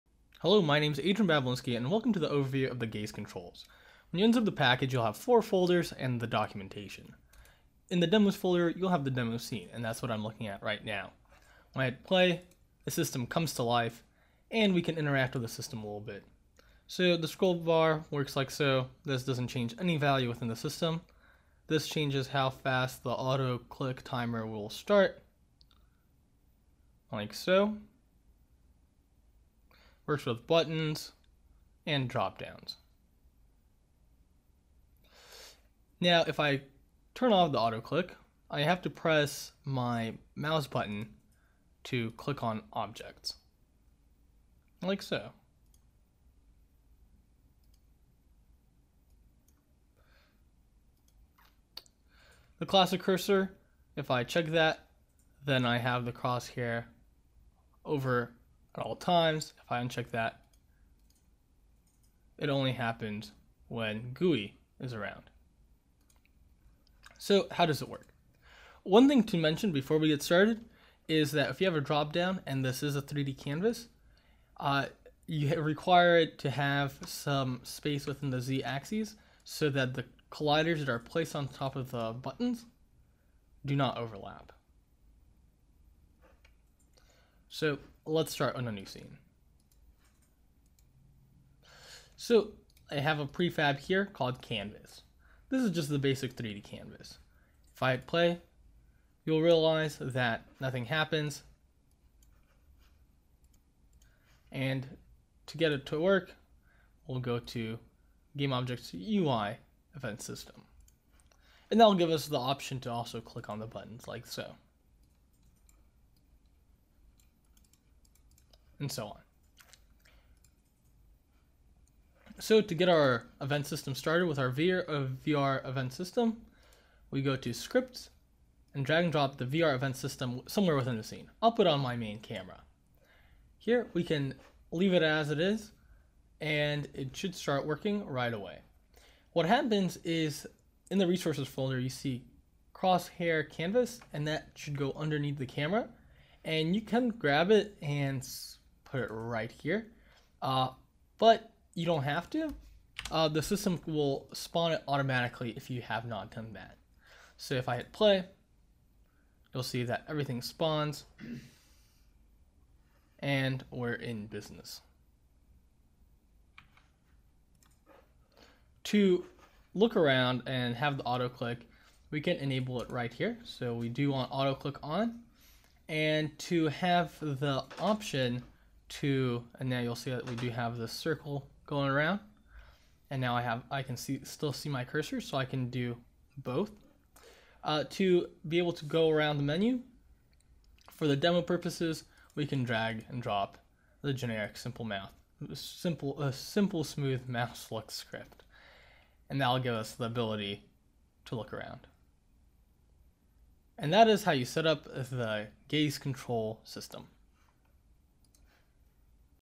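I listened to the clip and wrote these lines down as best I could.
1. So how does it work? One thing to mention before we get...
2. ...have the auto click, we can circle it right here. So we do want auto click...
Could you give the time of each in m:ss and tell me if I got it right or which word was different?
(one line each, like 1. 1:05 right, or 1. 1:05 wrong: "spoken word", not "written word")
1. 1:07 right
2. 2:50 wrong: "enable", not "circle".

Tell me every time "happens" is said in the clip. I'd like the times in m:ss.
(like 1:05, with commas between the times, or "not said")
1:02, 1:40, 2:19.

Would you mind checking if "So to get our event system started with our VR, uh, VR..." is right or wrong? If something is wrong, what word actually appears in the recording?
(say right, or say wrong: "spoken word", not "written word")
right.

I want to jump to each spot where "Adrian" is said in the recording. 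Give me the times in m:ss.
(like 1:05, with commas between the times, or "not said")
0:00.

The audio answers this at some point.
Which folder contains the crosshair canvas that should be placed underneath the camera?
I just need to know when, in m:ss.
2:21.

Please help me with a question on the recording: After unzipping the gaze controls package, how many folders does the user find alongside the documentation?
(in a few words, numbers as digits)
4.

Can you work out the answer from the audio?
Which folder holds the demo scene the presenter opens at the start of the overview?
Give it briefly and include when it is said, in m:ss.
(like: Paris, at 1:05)
Demos folder, at 0:08.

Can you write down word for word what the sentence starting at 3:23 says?
And that is how you set up the gaze control system.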